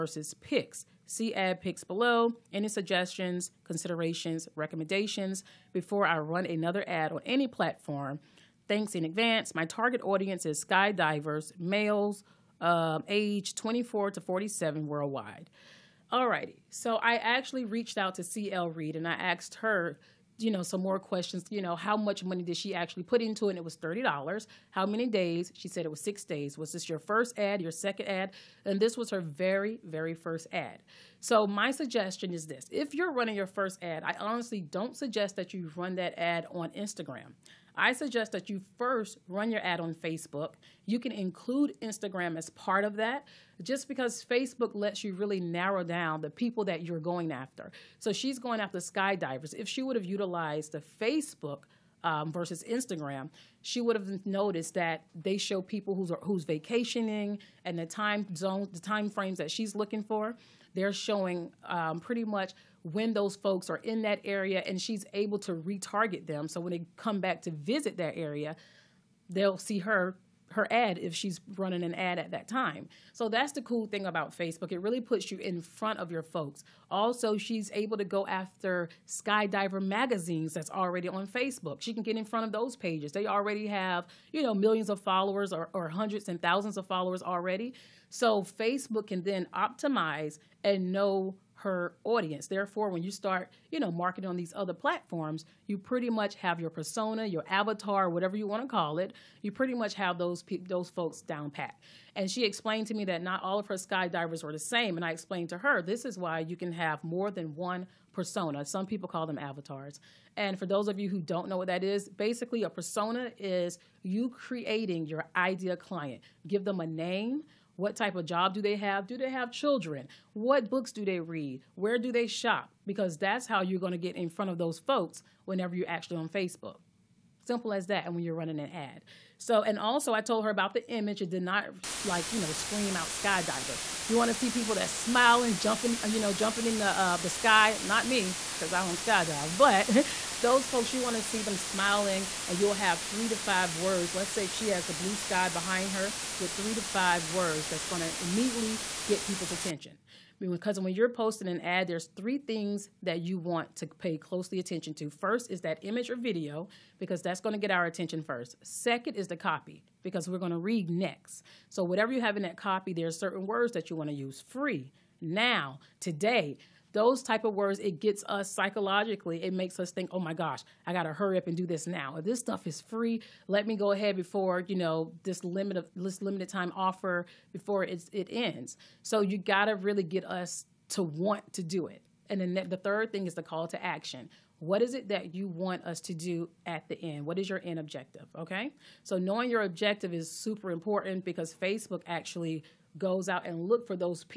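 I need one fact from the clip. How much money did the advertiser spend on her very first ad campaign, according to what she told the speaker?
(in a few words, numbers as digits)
$30.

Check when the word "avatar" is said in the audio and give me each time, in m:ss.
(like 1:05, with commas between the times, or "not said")
1:37, 1:49.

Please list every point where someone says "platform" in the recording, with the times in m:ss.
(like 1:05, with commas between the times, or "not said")
0:07, 1:34.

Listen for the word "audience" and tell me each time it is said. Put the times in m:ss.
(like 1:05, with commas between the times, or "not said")
0:10, 1:32.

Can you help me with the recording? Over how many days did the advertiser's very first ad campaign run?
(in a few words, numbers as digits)
6.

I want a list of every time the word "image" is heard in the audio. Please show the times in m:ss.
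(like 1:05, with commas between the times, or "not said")
2:10, 2:35.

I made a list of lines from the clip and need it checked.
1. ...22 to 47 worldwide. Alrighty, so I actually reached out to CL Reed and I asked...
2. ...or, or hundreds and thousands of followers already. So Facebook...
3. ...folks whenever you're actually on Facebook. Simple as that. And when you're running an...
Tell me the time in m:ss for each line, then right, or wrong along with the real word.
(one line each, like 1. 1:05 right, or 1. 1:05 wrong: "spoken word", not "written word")
1. 0:13 wrong: "24", not "22"
2. 1:25 right
3. 2:04 right.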